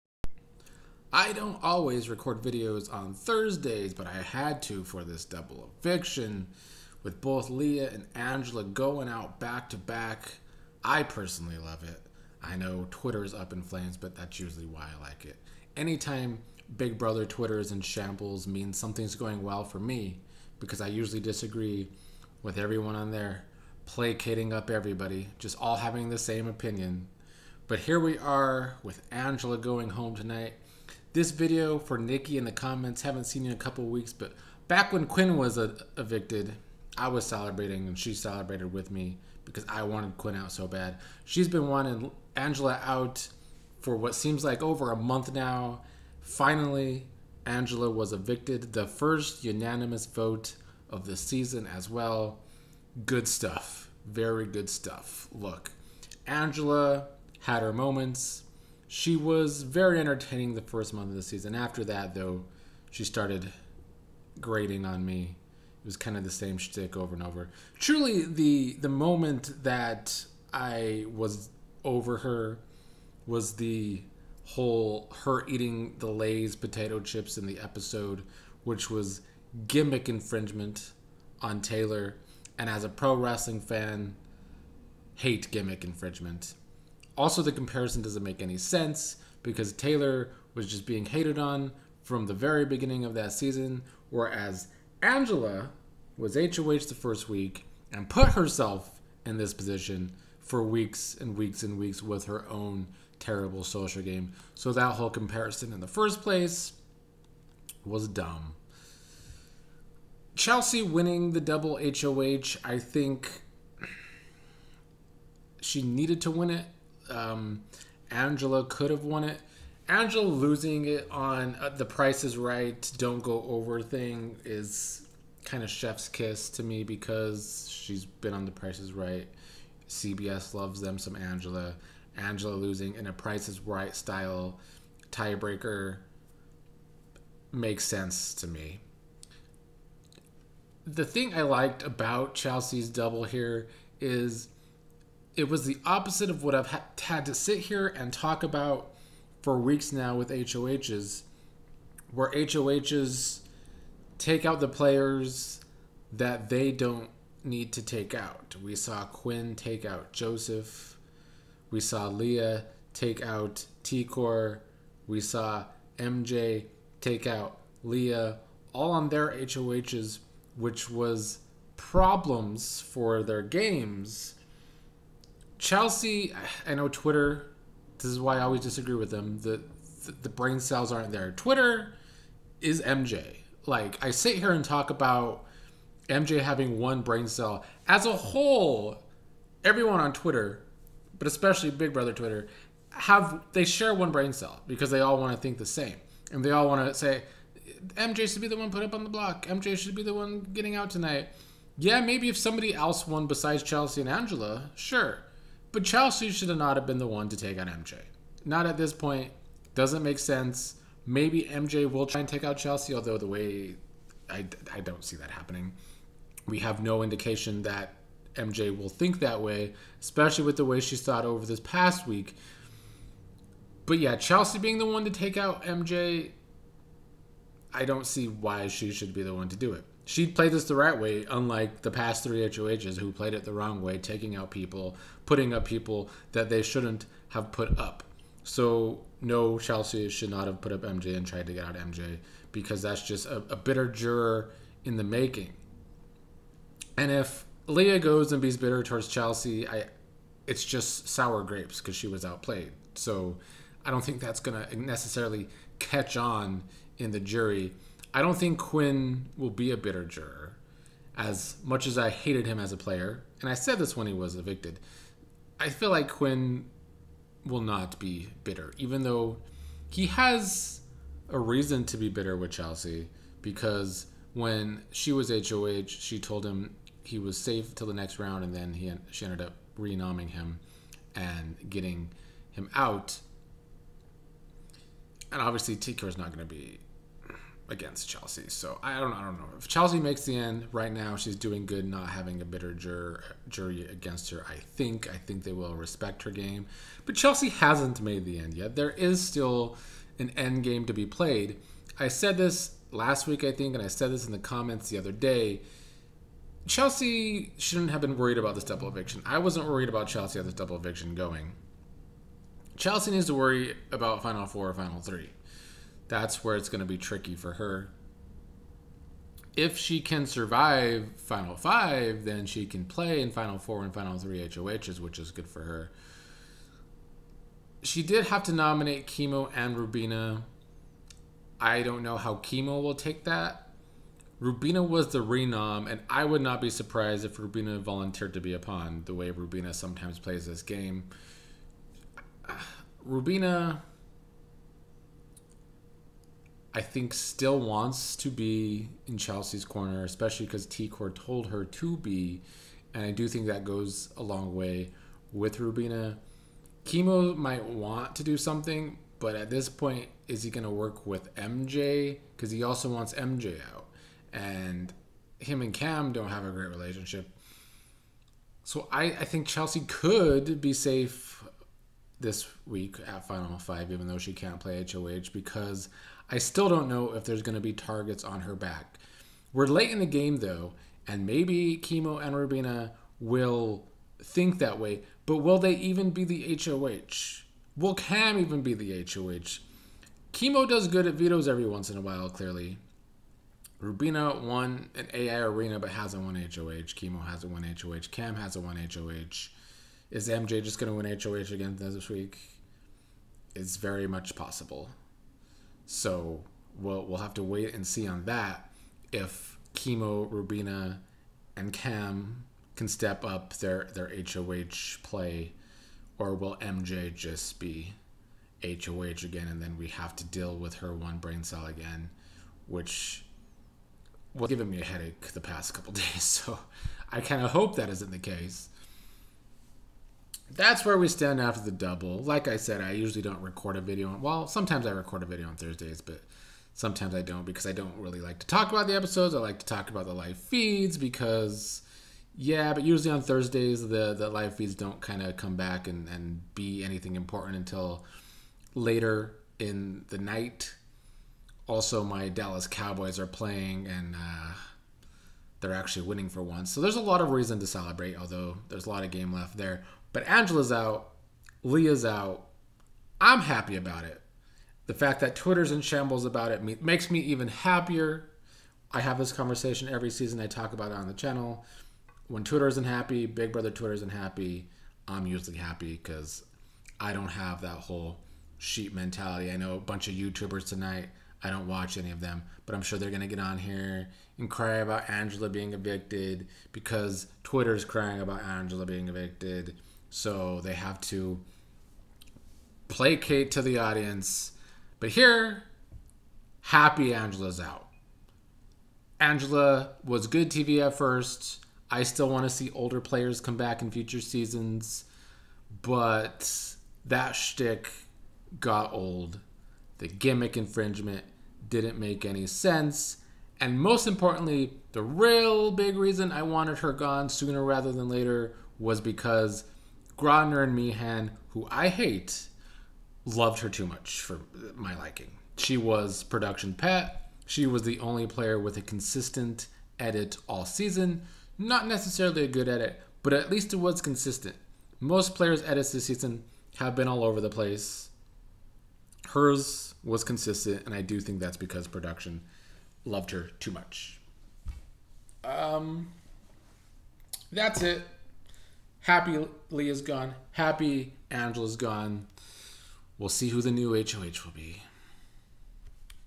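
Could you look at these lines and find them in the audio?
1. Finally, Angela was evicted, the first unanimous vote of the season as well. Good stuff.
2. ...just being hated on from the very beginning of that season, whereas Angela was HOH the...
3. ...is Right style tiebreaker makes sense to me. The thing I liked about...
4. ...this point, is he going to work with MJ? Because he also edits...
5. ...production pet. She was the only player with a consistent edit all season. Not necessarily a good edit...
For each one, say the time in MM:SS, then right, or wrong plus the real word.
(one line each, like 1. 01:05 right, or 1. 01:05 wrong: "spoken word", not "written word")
1. 00:46 right
2. 01:30 right
3. 02:13 right
4. 05:59 wrong: "wants", not "edits"
5. 08:46 right.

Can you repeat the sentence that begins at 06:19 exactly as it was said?
We're late in the game though, and maybe Kimo and Rubina will think that way, but will they even be the HOH?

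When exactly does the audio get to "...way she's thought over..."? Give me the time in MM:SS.
03:40.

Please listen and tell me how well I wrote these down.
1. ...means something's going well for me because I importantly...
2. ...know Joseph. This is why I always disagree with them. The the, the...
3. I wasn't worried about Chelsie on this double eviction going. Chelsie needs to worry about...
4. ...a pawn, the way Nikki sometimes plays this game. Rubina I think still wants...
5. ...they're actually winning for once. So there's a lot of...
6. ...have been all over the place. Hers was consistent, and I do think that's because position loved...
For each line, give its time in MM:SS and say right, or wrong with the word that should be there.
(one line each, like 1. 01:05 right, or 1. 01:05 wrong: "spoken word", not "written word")
1. 00:18 wrong: "usually", not "importantly"
2. 02:56 wrong: "Twitter", not "Joseph"
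3. 05:09 right
4. 05:38 wrong: "Rubina", not "Nikki"
5. 07:35 right
6. 08:56 wrong: "production", not "position".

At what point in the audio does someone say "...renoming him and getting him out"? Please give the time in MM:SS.
04:39.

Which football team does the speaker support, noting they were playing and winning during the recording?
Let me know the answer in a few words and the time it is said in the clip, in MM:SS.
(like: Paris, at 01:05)
Dallas Cowboys, at 07:32.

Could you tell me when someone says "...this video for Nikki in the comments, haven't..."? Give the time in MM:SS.
00:31.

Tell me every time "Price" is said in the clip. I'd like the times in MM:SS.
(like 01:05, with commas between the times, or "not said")
02:01, 02:08, 02:13.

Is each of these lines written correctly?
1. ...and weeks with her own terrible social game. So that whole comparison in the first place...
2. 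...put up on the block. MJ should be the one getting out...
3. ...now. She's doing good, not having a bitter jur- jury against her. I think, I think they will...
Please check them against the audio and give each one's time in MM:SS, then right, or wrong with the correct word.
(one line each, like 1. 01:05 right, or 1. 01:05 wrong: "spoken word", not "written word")
1. 01:41 right
2. 03:18 right
3. 04:50 right.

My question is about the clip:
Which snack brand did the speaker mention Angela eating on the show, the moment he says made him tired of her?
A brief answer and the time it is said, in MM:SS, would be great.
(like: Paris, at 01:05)
Lay's potato chips, at 01:16.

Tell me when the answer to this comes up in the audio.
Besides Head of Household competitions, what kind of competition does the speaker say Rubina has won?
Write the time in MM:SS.
06:35.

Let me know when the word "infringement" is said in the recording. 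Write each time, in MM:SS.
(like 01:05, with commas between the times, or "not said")
01:20, 01:25, 08:30.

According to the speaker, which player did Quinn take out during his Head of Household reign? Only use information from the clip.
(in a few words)
Joseph.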